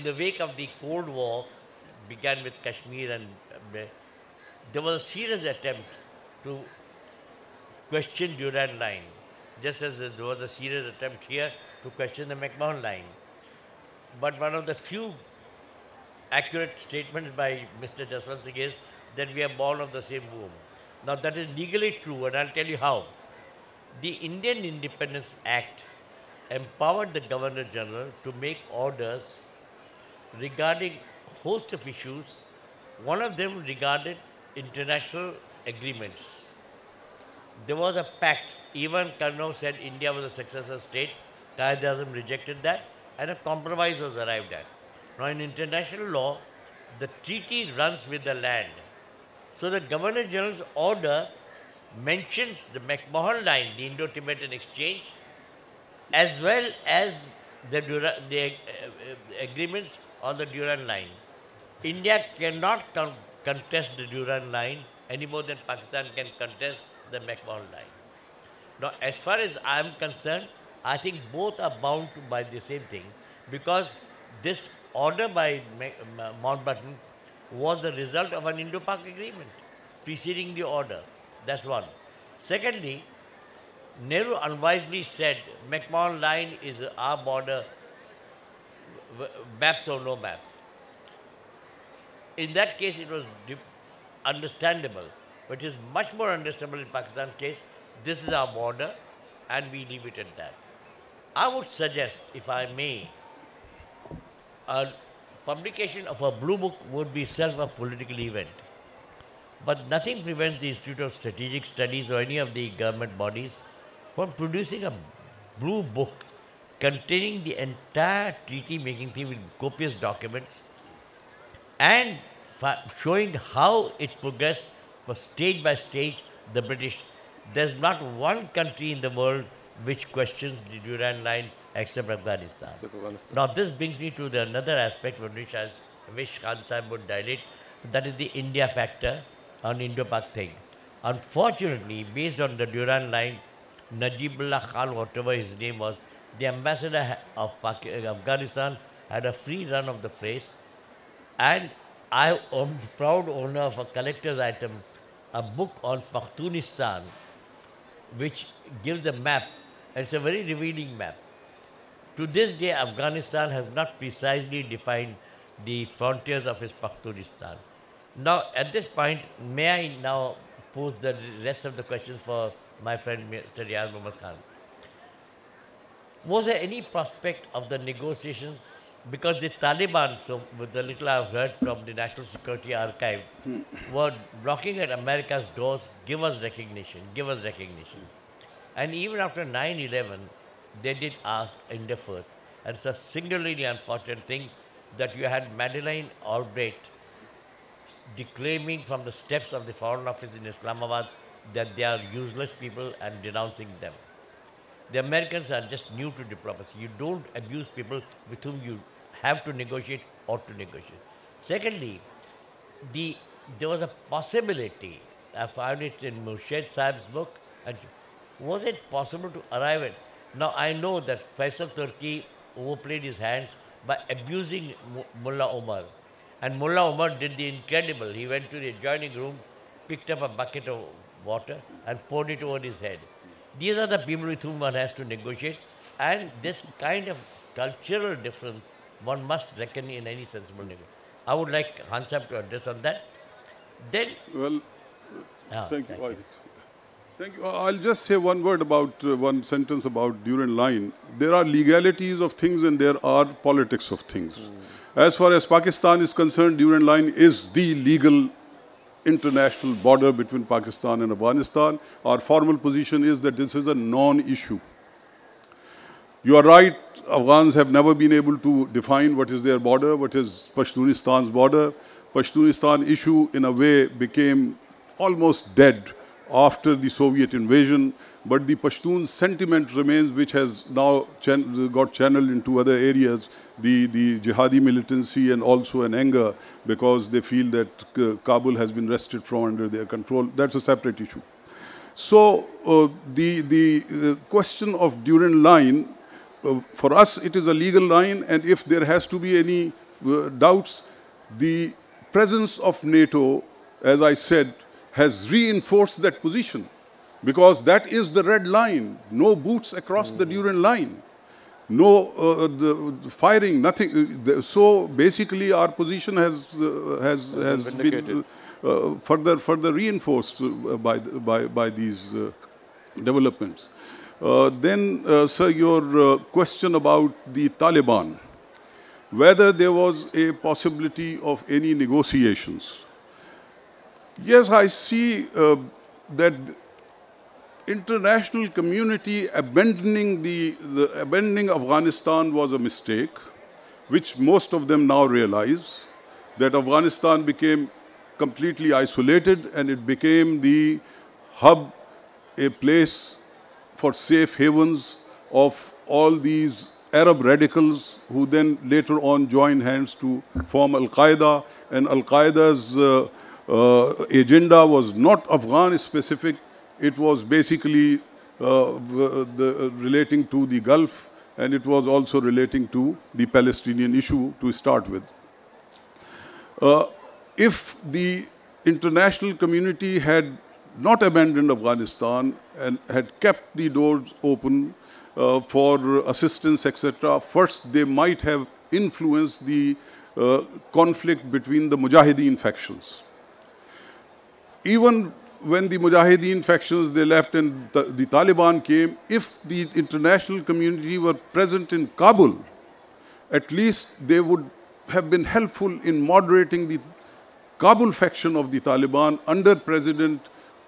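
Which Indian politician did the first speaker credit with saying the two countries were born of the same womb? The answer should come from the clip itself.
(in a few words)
Jaswant Singh.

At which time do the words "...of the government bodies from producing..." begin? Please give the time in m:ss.
1:52.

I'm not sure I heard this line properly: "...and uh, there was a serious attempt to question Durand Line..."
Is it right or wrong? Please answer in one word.
right.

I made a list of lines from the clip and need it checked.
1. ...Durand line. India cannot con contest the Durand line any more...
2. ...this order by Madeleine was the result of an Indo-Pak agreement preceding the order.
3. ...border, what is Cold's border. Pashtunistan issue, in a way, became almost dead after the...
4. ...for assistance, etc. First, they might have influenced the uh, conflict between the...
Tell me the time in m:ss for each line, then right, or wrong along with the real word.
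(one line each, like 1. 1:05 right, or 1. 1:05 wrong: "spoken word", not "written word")
1. 1:00 right
2. 1:14 wrong: "Mountbatten", not "Madeleine"
3. 4:29 wrong: "Pashtunistan", not "Cold"
4. 6:25 right.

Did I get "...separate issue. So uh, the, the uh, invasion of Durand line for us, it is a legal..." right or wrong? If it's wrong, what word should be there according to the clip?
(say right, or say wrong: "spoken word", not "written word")
wrong: "question", not "invasion".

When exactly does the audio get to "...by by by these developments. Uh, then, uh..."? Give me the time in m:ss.
5:20.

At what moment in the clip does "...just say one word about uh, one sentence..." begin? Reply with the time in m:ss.
4:07.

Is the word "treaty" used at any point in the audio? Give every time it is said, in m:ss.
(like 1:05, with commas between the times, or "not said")
0:47, 1:58.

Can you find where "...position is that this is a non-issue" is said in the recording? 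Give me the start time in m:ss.
4:22.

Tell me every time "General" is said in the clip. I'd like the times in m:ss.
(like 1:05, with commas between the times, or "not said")
0:27, 0:50.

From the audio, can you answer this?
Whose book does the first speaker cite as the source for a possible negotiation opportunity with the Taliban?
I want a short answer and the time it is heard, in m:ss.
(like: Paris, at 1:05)
Murshed Saab, at 3:36.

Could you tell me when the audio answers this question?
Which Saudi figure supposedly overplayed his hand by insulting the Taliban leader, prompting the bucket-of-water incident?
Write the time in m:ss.
3:41.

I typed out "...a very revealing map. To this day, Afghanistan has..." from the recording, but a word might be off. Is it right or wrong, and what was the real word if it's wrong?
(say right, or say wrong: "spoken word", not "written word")
right.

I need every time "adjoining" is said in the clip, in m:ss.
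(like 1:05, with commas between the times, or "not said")
3:48.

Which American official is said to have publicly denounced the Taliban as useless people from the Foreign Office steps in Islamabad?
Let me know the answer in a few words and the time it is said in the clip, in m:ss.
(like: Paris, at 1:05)
Madeleine Albright, at 3:15.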